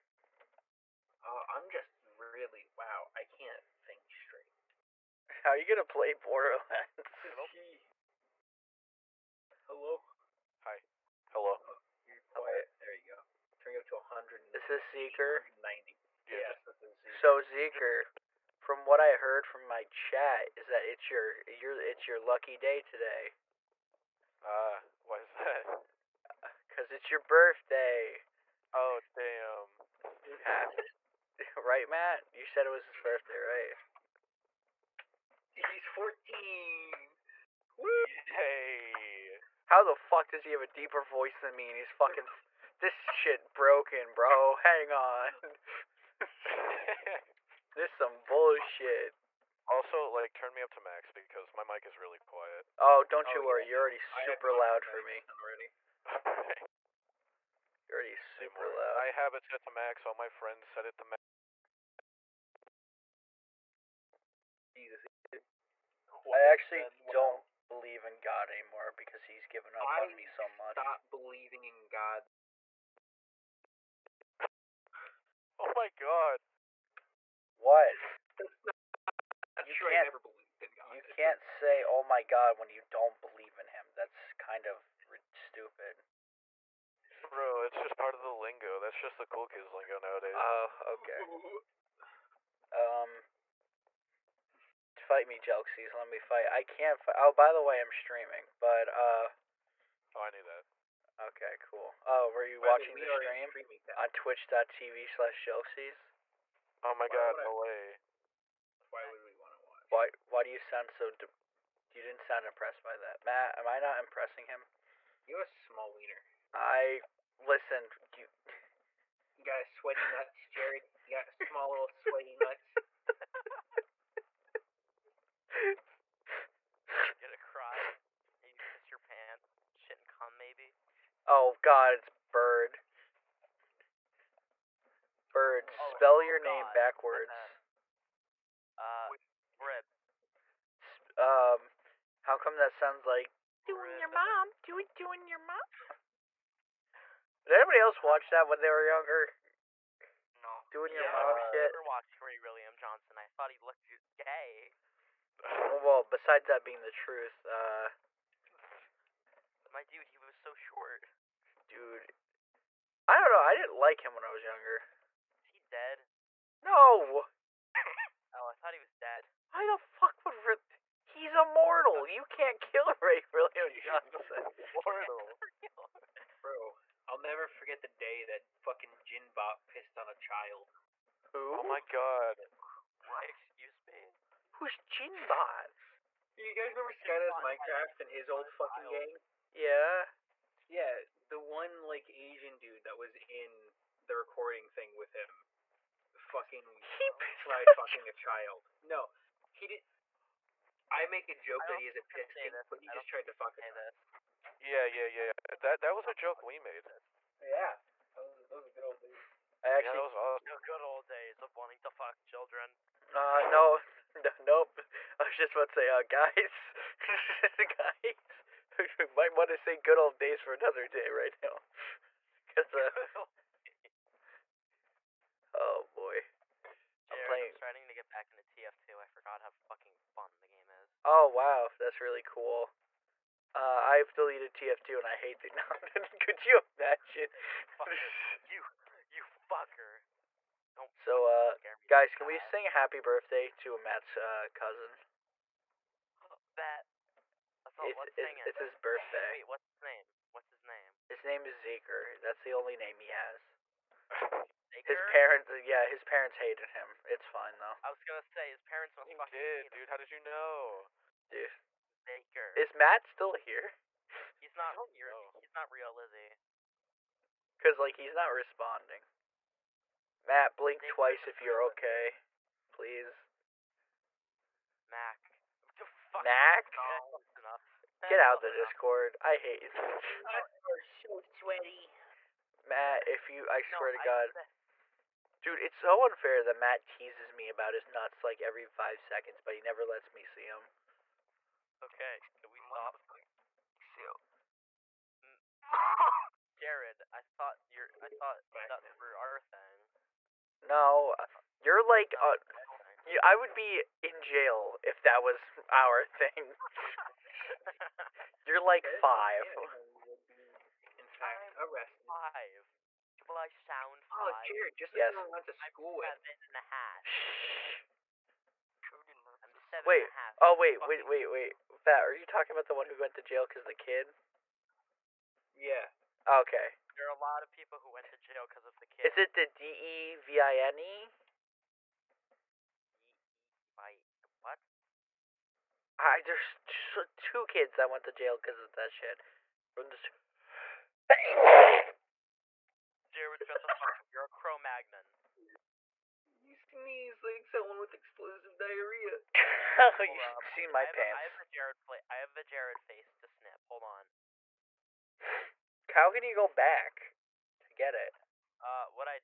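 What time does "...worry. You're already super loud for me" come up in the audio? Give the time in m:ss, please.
0:53.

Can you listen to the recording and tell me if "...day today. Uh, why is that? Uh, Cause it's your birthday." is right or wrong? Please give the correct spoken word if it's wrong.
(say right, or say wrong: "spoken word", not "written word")
right.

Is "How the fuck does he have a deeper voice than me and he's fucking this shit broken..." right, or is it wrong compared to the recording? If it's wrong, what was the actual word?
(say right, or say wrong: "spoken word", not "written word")
right.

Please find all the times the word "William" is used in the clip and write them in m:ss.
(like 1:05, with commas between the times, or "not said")
2:32, 2:53.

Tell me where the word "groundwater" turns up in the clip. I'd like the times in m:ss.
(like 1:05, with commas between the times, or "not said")
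not said.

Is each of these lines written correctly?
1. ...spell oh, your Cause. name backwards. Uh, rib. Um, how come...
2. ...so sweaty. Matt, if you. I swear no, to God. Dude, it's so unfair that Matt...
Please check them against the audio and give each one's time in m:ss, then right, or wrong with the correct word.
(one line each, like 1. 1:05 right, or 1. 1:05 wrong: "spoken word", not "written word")
1. 2:15 wrong: "God", not "Cause"
2. 4:40 right.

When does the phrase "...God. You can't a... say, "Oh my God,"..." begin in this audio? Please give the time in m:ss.
1:20.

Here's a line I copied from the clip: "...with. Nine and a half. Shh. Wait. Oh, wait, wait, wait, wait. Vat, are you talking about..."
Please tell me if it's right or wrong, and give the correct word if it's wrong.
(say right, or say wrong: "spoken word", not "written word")
wrong: "Seven", not "Nine".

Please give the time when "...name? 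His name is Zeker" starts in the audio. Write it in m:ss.
4:10.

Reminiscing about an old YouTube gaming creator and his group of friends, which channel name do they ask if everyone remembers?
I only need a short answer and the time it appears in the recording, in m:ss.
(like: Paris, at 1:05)
SkyDoesMinecraft, at 3:06.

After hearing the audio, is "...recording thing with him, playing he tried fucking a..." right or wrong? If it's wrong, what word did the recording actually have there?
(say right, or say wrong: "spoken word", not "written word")
wrong: "fucking", not "playing".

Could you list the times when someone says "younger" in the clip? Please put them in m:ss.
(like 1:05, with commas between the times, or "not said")
2:28, 2:44.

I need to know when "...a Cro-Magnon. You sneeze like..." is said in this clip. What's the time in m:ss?
5:44.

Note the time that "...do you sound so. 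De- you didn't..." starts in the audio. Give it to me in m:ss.
1:50.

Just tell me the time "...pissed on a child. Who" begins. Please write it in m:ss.
2:59.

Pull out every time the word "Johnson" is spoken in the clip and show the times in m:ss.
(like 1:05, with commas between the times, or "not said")
2:32, 2:53.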